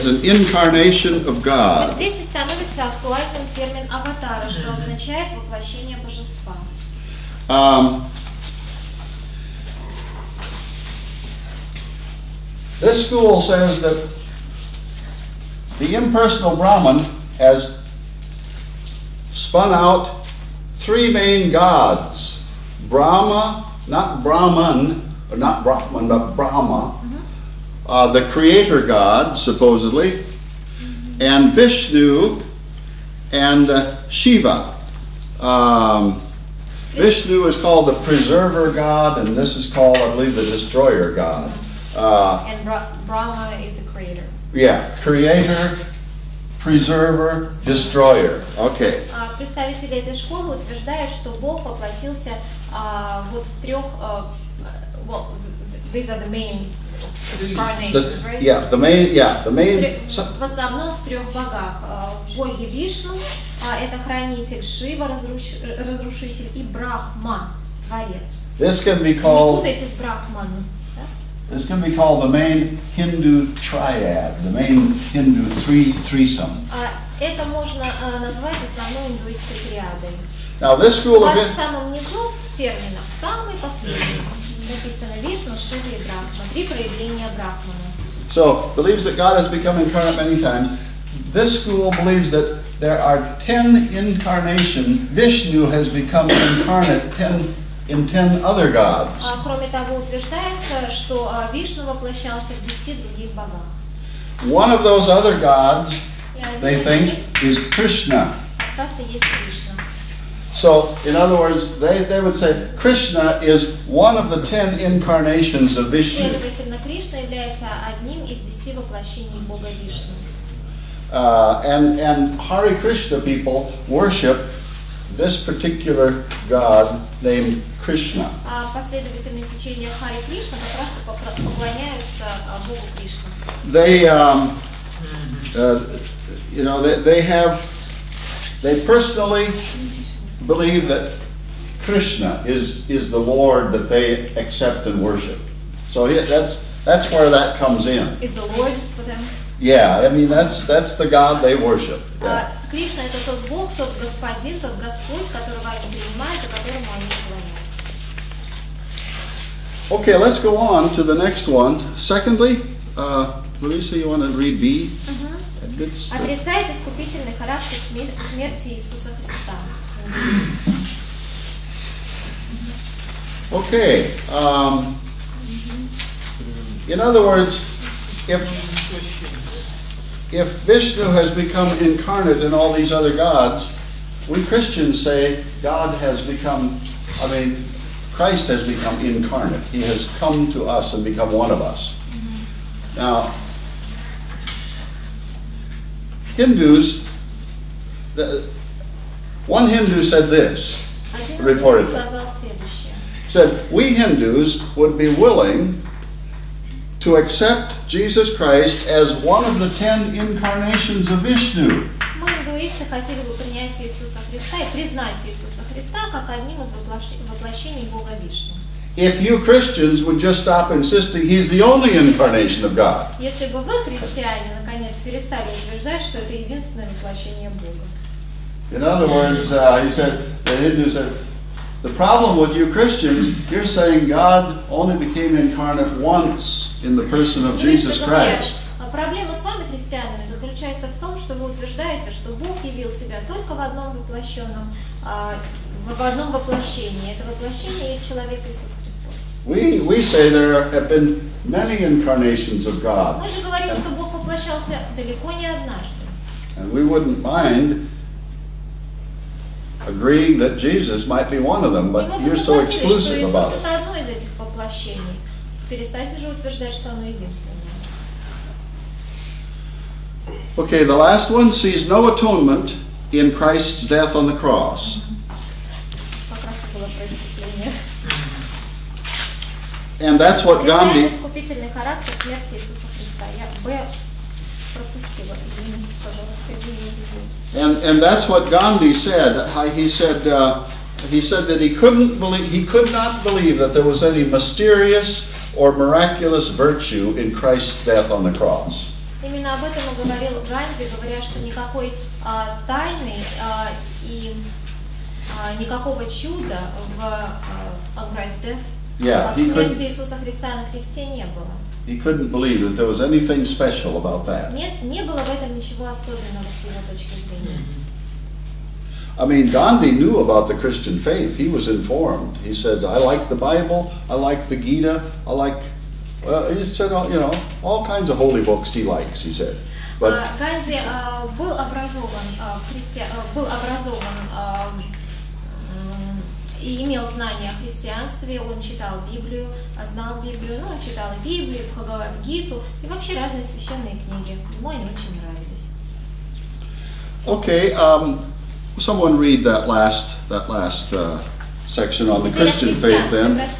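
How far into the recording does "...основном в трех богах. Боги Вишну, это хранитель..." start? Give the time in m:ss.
1:00.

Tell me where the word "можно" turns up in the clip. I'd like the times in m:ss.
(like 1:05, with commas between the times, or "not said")
1:17.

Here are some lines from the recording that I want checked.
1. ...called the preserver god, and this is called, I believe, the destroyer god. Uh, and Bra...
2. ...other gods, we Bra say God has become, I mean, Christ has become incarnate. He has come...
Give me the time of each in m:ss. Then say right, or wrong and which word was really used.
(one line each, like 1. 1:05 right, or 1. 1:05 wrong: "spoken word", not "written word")
1. 0:37 right
2. 3:02 wrong: "Christians", not "Bra".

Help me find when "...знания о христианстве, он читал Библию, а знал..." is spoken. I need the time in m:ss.
5:37.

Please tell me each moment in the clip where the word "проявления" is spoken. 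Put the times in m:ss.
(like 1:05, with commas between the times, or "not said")
1:26.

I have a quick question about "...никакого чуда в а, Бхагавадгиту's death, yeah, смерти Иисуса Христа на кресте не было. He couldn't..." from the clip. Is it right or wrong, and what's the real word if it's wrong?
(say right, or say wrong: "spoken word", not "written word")
wrong: "Christ", not "Бхагавадгиту".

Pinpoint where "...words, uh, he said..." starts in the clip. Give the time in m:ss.
3:49.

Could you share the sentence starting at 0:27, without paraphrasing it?
uh, the creator god, supposedly, mm-hmm.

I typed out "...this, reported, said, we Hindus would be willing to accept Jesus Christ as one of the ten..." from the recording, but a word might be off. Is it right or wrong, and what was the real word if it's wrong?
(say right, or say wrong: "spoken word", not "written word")
right.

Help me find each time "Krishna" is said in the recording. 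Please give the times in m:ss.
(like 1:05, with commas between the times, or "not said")
1:47, 1:52, 2:02, 2:07, 2:21.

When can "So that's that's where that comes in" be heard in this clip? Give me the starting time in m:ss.
2:25.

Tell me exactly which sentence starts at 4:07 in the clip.
Это воплощение есть человек Иисус Христос.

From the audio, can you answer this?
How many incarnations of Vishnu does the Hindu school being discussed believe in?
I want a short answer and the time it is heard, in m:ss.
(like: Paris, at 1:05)
10, at 1:33.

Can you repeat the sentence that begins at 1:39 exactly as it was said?
Кроме того, утверждается, что Вишну воплощался в десяти других богах.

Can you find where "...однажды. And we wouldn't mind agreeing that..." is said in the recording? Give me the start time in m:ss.
4:15.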